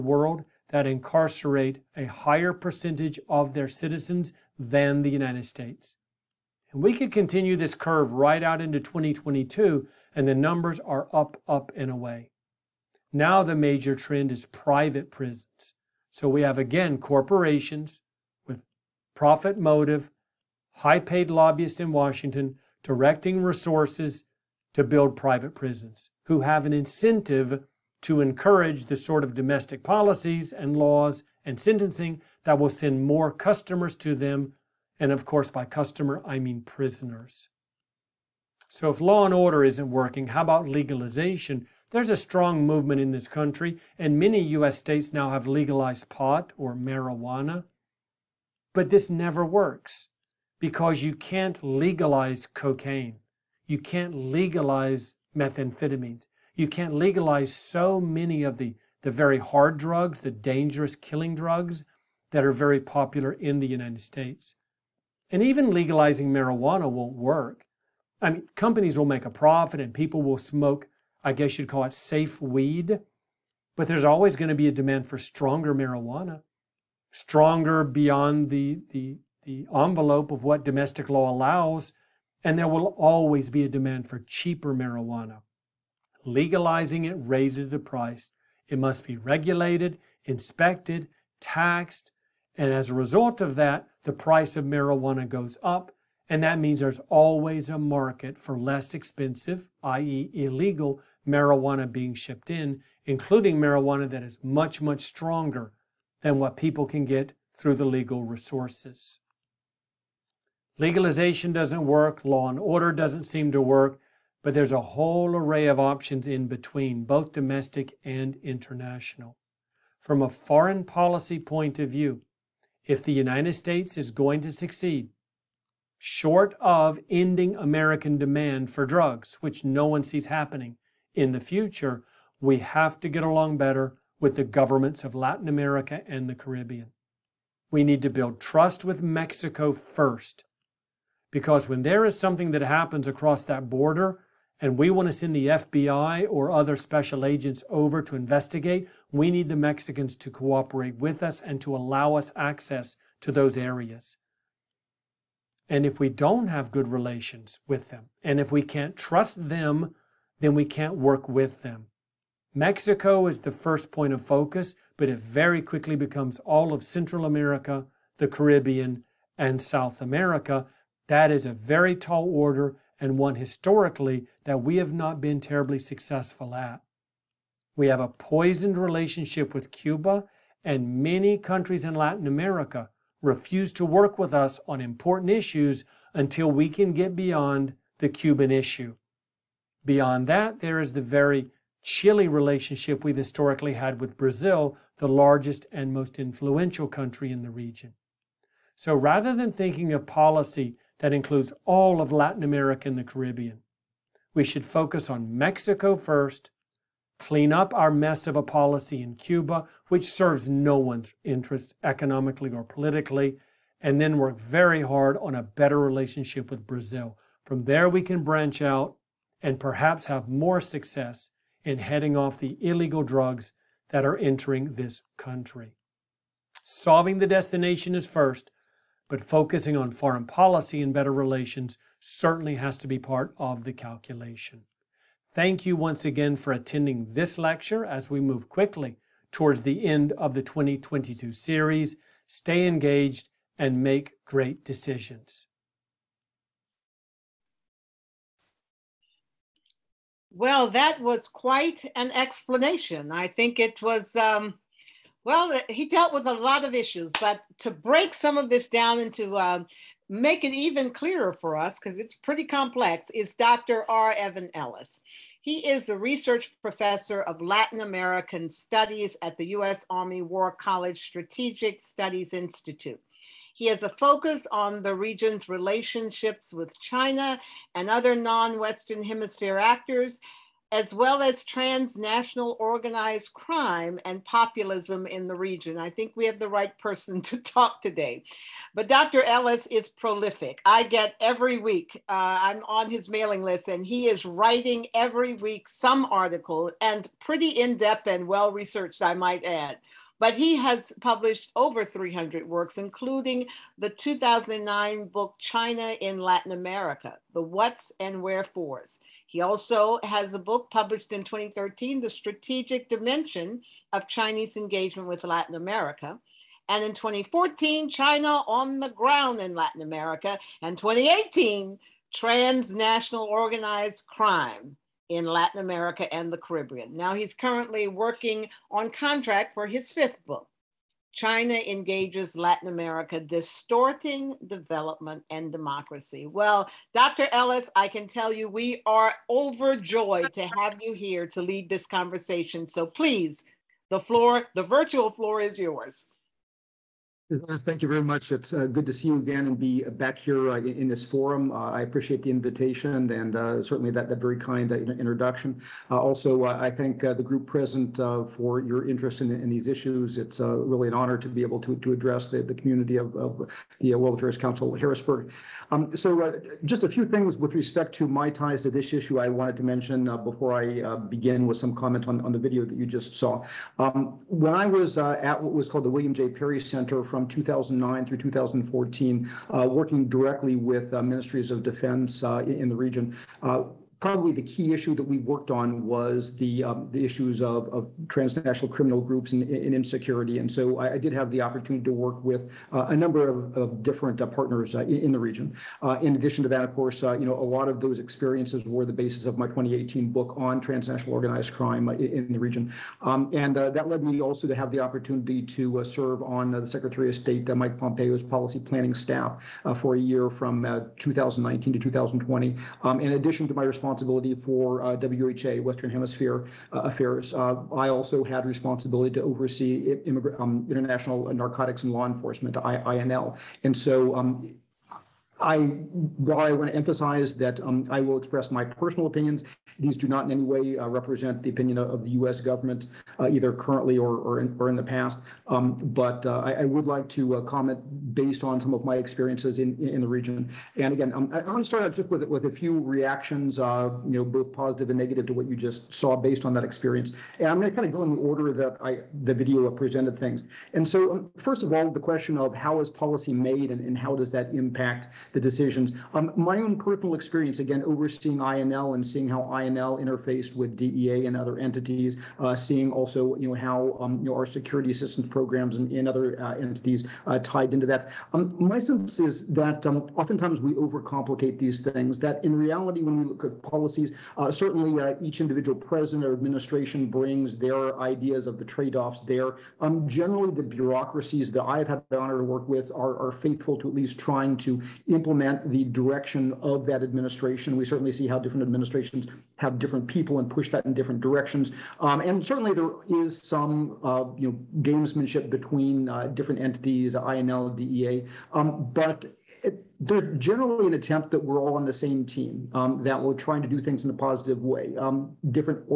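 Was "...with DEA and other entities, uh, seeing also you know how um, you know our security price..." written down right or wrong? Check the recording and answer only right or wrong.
wrong.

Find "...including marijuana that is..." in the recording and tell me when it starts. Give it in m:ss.
1:43.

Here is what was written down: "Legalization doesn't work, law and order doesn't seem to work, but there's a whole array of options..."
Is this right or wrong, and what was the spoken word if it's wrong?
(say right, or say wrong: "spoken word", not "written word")
right.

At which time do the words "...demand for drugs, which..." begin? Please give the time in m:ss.
2:08.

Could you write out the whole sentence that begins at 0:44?
states now have legalized pot or marijuana.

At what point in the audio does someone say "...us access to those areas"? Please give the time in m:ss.
2:32.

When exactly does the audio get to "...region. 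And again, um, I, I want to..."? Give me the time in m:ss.
7:20.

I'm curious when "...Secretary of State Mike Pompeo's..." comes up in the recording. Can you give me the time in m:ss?
6:46.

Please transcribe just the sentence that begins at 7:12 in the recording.
government, uh, either currently or, or, in, or in the past.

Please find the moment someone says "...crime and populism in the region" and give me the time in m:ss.
4:43.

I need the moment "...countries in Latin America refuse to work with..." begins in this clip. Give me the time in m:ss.
3:01.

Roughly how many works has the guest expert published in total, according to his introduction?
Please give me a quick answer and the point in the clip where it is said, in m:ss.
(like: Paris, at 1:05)
over 300, at 5:01.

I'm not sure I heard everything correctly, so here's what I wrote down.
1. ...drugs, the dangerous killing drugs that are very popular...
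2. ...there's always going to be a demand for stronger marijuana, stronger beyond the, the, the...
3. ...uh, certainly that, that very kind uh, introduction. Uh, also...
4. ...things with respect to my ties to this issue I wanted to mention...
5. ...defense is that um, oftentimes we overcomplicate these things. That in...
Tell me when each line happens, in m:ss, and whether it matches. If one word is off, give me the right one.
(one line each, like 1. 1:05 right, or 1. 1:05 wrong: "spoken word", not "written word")
1. 0:59 right
2. 1:13 right
3. 5:53 right
4. 6:07 right
5. 7:48 wrong: "sense", not "defense".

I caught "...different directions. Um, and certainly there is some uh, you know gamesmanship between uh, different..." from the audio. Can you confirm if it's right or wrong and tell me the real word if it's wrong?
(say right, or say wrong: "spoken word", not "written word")
right.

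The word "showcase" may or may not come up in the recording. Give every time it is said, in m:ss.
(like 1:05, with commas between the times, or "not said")
not said.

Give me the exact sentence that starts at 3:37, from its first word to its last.
From there, we can branch out and perhaps have more success in heading off the illegal drugs that are entering this country.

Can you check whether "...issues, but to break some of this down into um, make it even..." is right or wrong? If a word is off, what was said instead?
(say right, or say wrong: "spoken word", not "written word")
right.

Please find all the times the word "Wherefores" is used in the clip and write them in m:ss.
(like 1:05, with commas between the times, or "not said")
5:08.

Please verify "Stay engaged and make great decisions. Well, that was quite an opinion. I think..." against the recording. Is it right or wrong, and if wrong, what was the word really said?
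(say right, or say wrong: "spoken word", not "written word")
wrong: "explanation", not "opinion".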